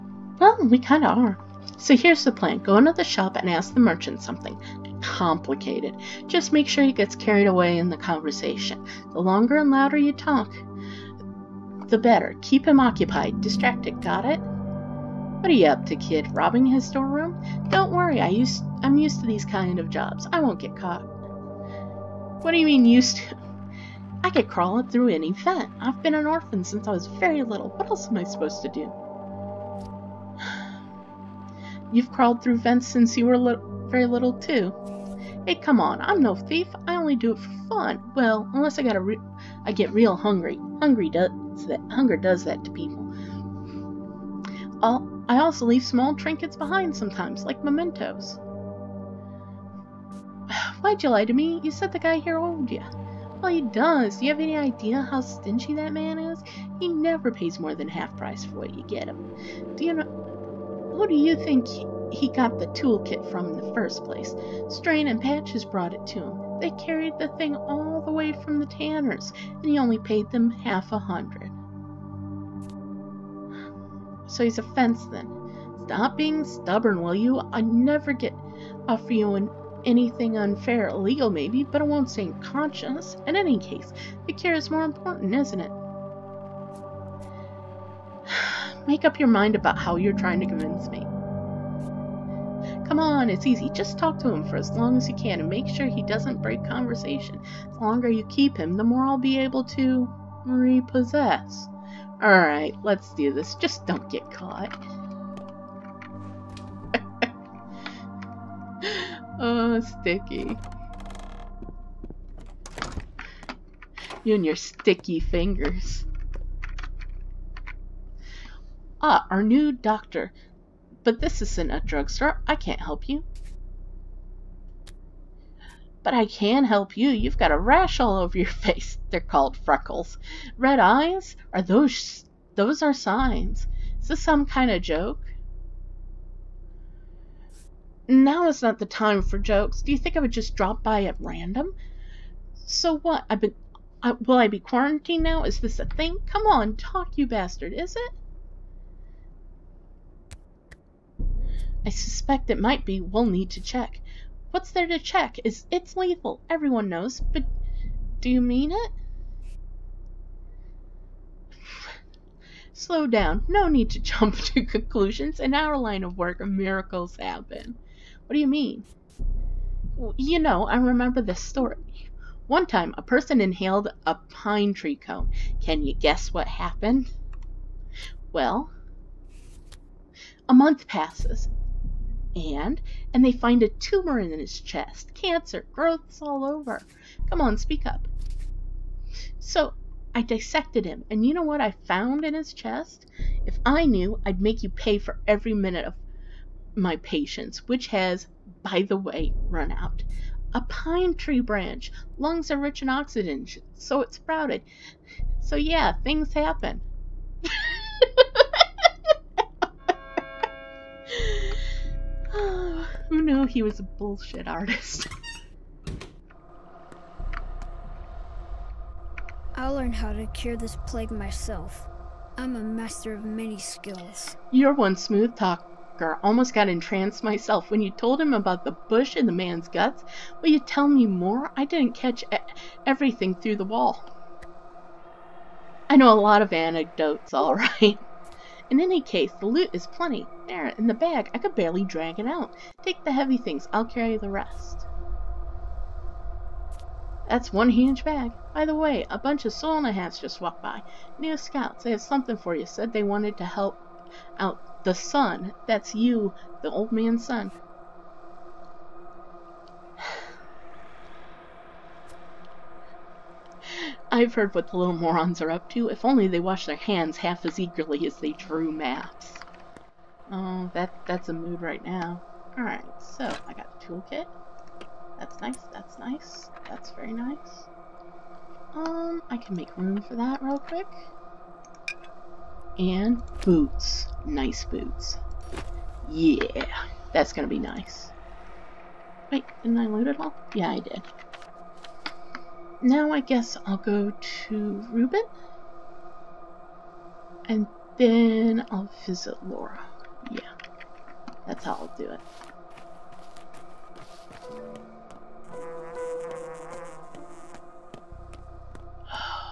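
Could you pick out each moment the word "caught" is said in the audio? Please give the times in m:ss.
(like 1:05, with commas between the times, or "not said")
0:20, 1:44.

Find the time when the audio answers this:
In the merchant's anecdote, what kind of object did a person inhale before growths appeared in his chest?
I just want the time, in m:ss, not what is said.
2:54.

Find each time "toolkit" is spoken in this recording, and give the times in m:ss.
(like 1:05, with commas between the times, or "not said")
1:02, 4:33.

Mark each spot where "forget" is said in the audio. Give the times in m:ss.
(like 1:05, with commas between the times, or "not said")
not said.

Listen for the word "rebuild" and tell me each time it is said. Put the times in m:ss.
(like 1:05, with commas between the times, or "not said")
not said.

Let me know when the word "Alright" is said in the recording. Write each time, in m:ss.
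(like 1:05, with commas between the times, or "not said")
1:42, 4:32.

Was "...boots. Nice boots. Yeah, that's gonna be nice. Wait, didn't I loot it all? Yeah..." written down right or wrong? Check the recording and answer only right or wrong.
right.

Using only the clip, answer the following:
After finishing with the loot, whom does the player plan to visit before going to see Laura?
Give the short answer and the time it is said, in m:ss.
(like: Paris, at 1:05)
Rubin, at 4:54.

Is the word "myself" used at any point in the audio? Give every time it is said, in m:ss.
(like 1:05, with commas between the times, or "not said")
3:41, 3:47.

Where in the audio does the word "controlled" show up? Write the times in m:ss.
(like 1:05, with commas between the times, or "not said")
not said.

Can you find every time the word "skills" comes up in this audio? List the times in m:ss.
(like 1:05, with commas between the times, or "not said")
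3:43.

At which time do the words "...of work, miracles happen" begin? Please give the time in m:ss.
2:46.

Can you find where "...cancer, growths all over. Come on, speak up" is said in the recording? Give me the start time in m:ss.
3:05.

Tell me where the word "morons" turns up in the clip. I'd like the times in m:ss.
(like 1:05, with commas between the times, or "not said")
4:24.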